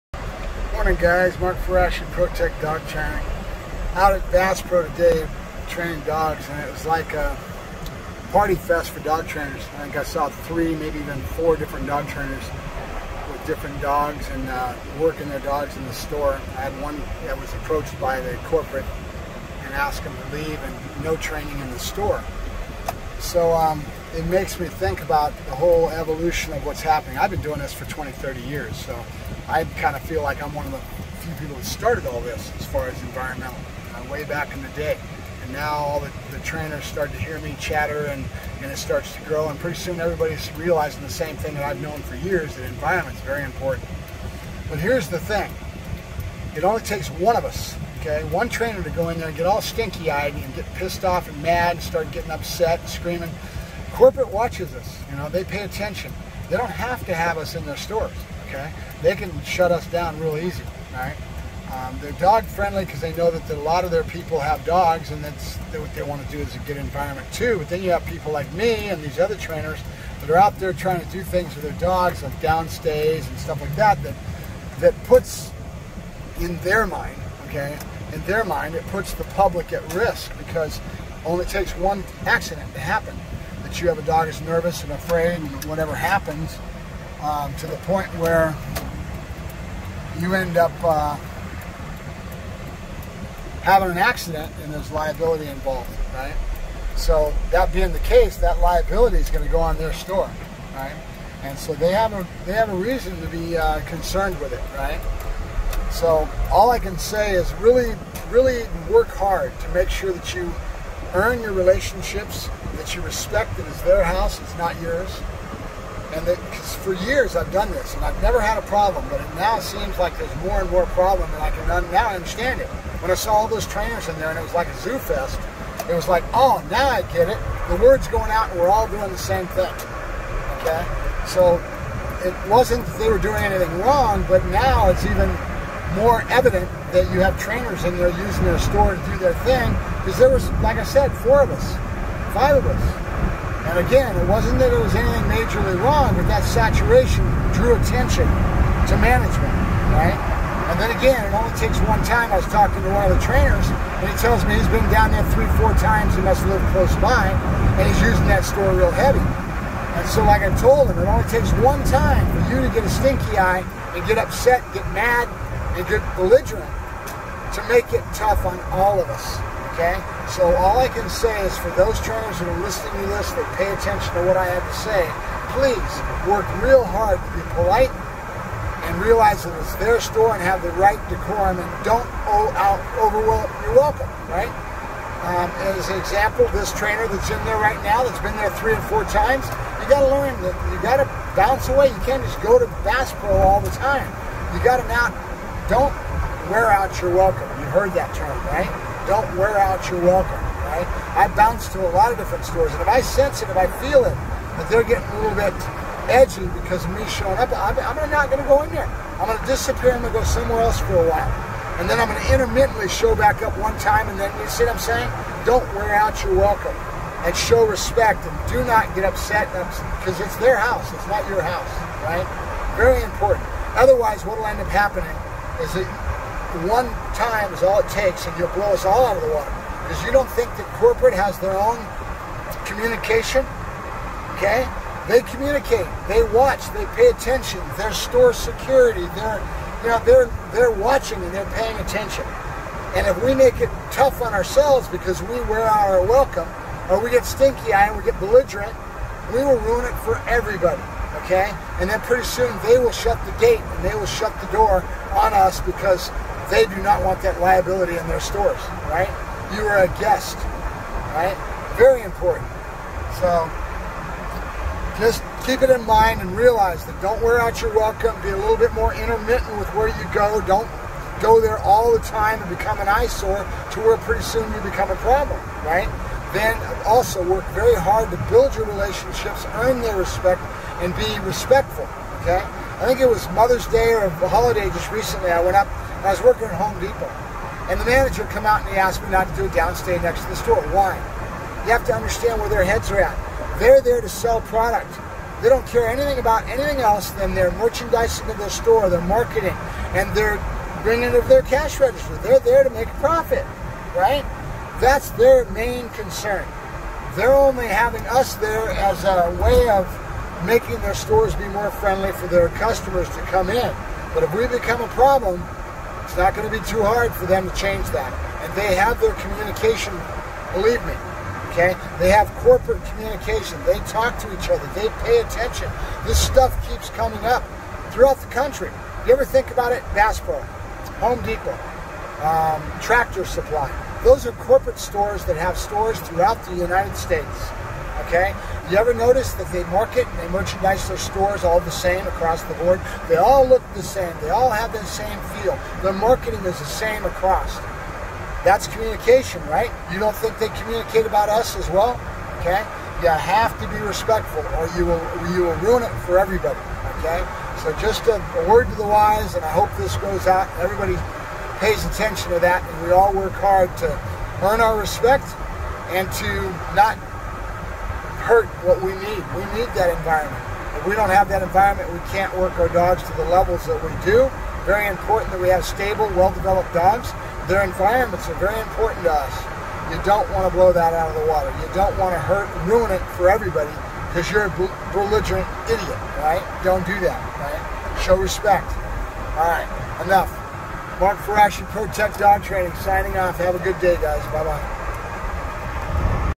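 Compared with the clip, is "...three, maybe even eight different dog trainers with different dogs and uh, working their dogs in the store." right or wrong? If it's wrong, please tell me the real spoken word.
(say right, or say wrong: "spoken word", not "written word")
wrong: "four", not "eight".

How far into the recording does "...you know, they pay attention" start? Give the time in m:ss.
0:55.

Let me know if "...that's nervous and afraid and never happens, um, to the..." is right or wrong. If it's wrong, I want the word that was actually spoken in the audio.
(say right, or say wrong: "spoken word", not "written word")
wrong: "whatever", not "never".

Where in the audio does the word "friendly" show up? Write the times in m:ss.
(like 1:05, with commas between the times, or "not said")
1:02, 5:11.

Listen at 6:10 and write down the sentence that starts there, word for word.
If we don't have that environment, we can't work our dogs to the levels that we do.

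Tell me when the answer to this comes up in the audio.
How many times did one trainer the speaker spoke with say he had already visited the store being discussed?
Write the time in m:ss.
2:35.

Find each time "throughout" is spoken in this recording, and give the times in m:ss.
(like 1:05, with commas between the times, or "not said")
5:27, 5:36.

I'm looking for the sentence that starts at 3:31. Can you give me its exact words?
And then I'm going to intermittently show back up one time, and then you see what I'm saying?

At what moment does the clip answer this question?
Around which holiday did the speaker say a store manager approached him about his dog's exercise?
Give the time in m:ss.
4:43.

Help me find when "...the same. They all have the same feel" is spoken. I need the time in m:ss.
5:43.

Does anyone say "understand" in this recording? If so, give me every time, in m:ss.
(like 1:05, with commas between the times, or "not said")
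2:02, 4:51.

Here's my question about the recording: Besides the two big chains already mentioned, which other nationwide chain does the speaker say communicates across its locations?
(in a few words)
Tractor Supply.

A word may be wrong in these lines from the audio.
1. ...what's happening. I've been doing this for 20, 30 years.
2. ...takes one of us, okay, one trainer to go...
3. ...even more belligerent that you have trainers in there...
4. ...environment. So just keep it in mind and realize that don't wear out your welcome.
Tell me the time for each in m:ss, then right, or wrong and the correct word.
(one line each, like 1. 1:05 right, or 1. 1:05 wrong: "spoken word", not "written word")
1. 0:26 right
2. 0:46 right
3. 2:15 wrong: "evident", not "belligerent"
4. 4:22 wrong: "important", not "environment".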